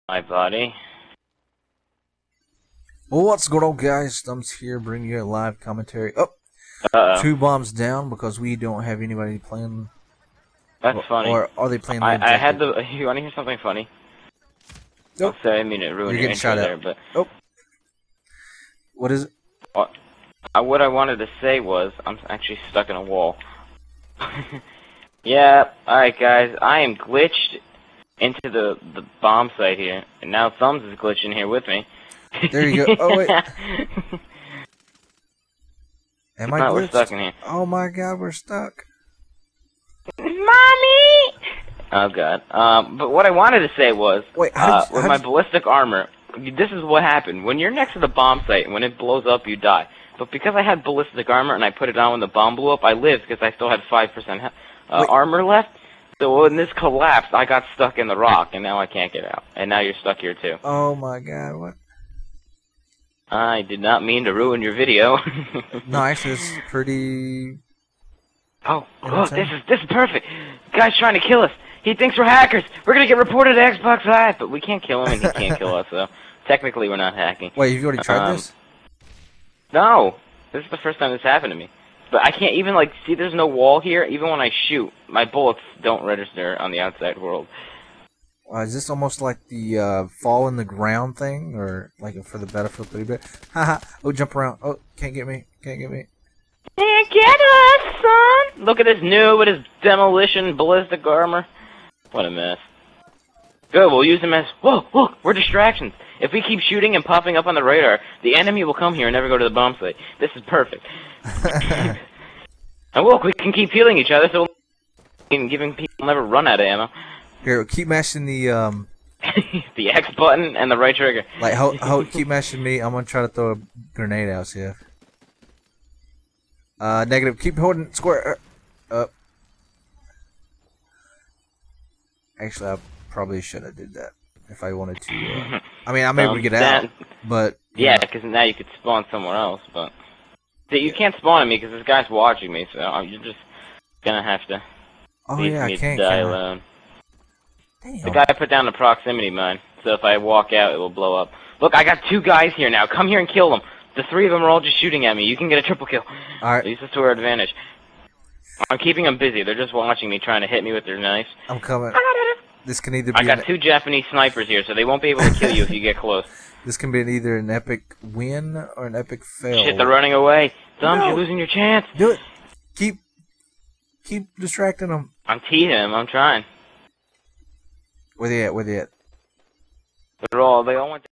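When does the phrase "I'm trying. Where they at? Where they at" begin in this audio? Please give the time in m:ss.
2:55.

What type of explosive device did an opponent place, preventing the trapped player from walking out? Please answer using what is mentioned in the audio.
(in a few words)
Proximity mine.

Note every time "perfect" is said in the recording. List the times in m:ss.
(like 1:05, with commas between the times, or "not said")
1:09, 1:50.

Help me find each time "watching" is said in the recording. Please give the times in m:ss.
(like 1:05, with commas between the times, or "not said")
2:22, 2:39.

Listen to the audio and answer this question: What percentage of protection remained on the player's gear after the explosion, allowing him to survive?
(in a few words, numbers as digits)
5%.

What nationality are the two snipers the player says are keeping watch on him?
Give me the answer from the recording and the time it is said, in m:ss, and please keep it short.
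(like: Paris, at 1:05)
Japanese, at 2:43.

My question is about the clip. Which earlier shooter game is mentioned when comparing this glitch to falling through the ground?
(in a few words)
Battlefield 3.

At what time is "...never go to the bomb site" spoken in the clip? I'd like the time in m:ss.
1:49.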